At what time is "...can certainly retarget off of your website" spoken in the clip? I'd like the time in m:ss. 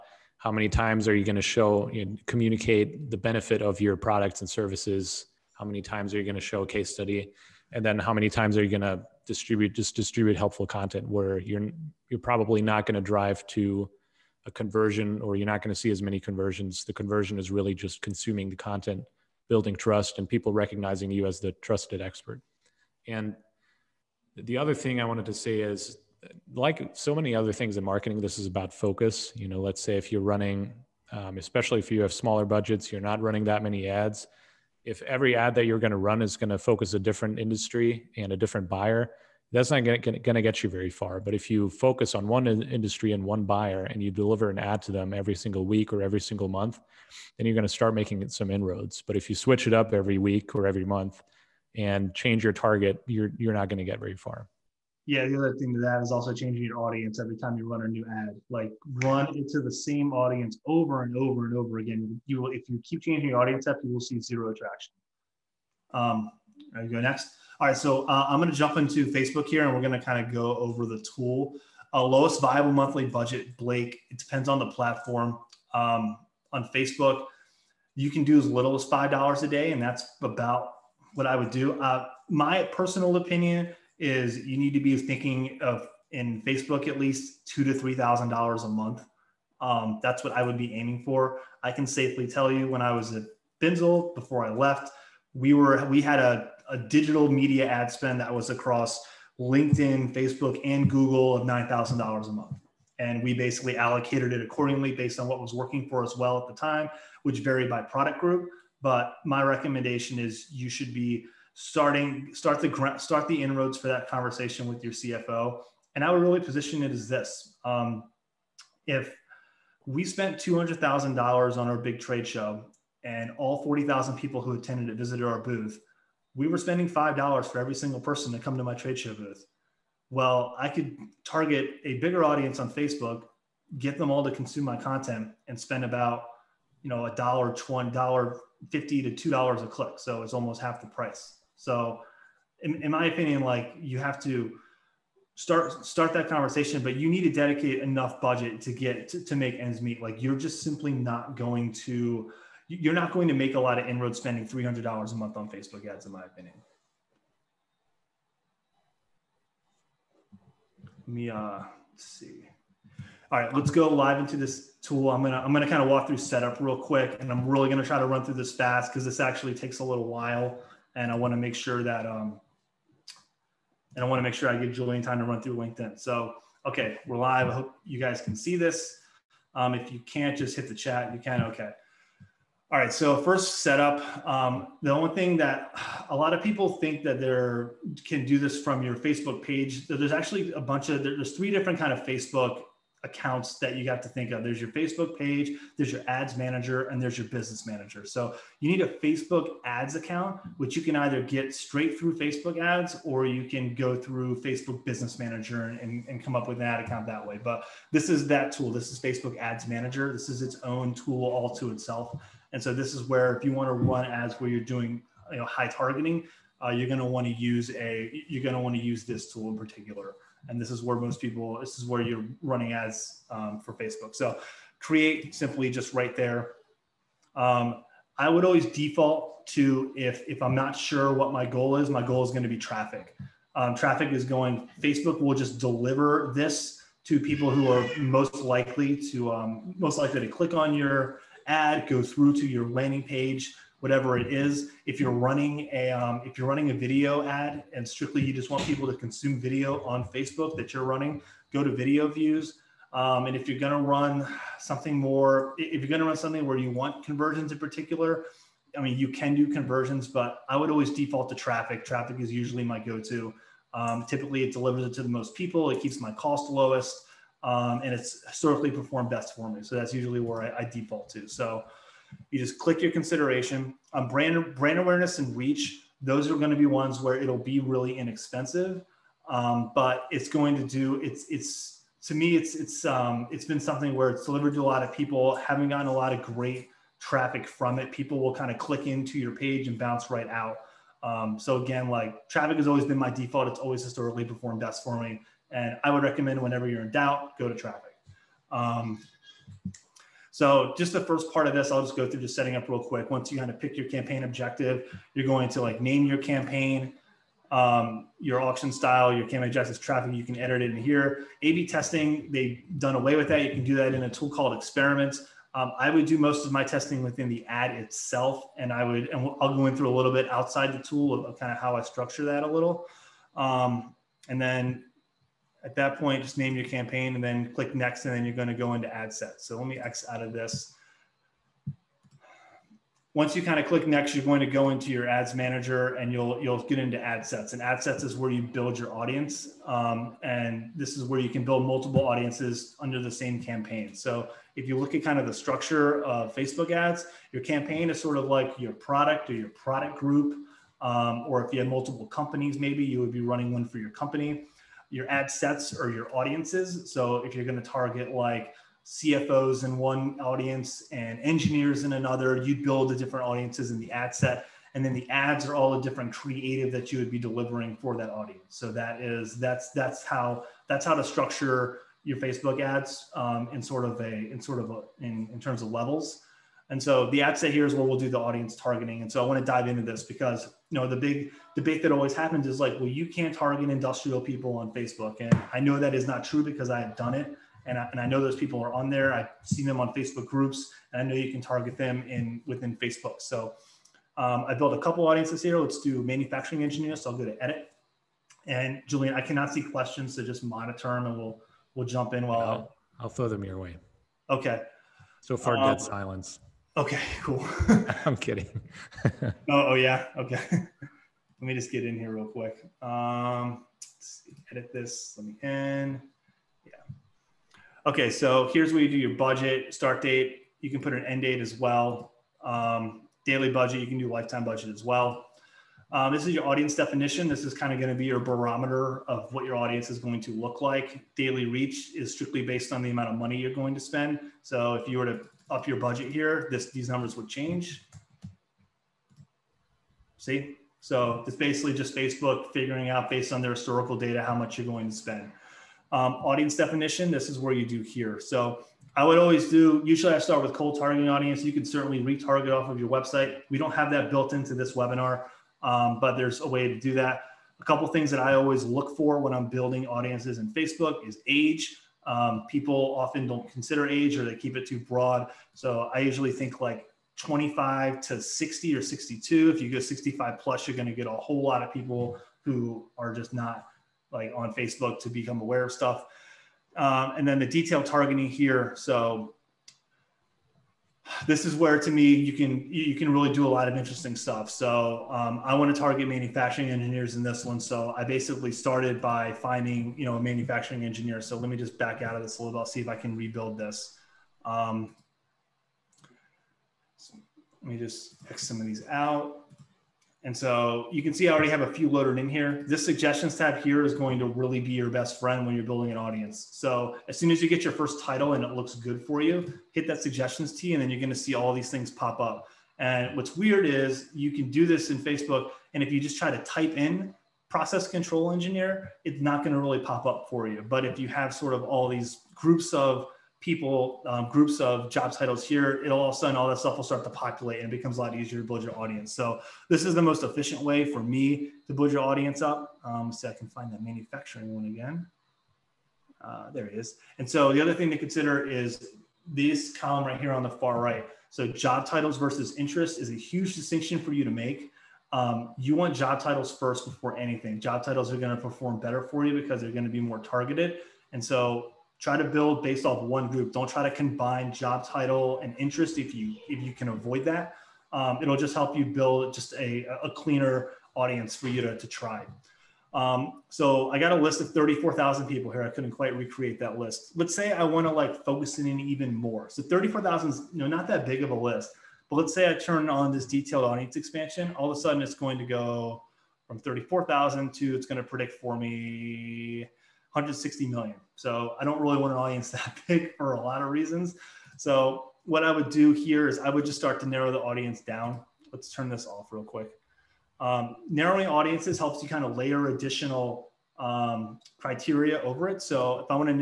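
7:31.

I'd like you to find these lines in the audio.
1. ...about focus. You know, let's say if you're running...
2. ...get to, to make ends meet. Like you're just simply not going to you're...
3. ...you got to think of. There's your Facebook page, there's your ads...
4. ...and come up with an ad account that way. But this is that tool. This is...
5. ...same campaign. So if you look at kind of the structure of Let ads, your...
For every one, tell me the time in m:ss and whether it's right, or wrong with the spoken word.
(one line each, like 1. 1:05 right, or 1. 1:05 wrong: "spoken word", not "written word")
1. 0:28 right
2. 2:28 right
3. 3:13 right
4. 3:26 right
5. 5:43 wrong: "Facebook", not "Let".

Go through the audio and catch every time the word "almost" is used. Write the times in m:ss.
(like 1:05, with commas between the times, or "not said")
2:20.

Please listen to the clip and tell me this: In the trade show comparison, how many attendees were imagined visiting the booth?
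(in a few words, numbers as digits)
40,000.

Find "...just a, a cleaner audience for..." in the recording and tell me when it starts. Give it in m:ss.
9:19.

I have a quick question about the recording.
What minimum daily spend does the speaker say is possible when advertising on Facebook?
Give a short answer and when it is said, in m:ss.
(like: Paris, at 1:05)
$5, at 1:18.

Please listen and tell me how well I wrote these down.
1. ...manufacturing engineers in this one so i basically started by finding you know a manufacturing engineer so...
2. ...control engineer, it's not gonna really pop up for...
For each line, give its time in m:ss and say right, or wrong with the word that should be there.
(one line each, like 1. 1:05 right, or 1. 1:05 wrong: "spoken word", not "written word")
1. 8:06 right
2. 8:37 right.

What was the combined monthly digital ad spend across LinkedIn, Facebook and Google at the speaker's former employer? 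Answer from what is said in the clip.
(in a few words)
$9,000.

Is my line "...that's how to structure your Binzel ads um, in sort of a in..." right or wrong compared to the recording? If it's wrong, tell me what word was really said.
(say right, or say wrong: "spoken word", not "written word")
wrong: "Facebook", not "Binzel".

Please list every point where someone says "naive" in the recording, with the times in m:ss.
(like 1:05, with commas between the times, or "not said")
not said.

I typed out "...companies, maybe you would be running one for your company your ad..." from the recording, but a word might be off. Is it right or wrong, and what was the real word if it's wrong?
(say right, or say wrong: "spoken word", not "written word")
right.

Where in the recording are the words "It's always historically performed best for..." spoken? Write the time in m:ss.
4:53.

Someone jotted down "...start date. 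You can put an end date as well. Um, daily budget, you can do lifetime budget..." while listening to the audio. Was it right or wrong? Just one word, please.
right.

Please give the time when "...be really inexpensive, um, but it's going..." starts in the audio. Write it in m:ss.
4:37.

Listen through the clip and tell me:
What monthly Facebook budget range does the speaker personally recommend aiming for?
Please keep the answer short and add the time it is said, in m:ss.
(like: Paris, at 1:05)
$2,000 to $3,000, at 1:27.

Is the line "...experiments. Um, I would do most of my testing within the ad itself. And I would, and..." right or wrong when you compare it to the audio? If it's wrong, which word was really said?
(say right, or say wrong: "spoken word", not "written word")
right.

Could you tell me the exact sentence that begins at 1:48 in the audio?
But my recommendation is you should be starting start the start the inroads for that conversation with your CFO.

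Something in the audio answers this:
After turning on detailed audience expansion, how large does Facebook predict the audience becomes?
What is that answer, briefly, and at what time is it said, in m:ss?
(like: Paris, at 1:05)
160 million, at 9:40.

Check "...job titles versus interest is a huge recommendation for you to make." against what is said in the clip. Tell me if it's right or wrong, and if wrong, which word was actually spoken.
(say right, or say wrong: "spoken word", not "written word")
wrong: "distinction", not "recommendation".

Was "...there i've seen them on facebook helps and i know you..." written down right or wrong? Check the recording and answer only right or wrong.
wrong.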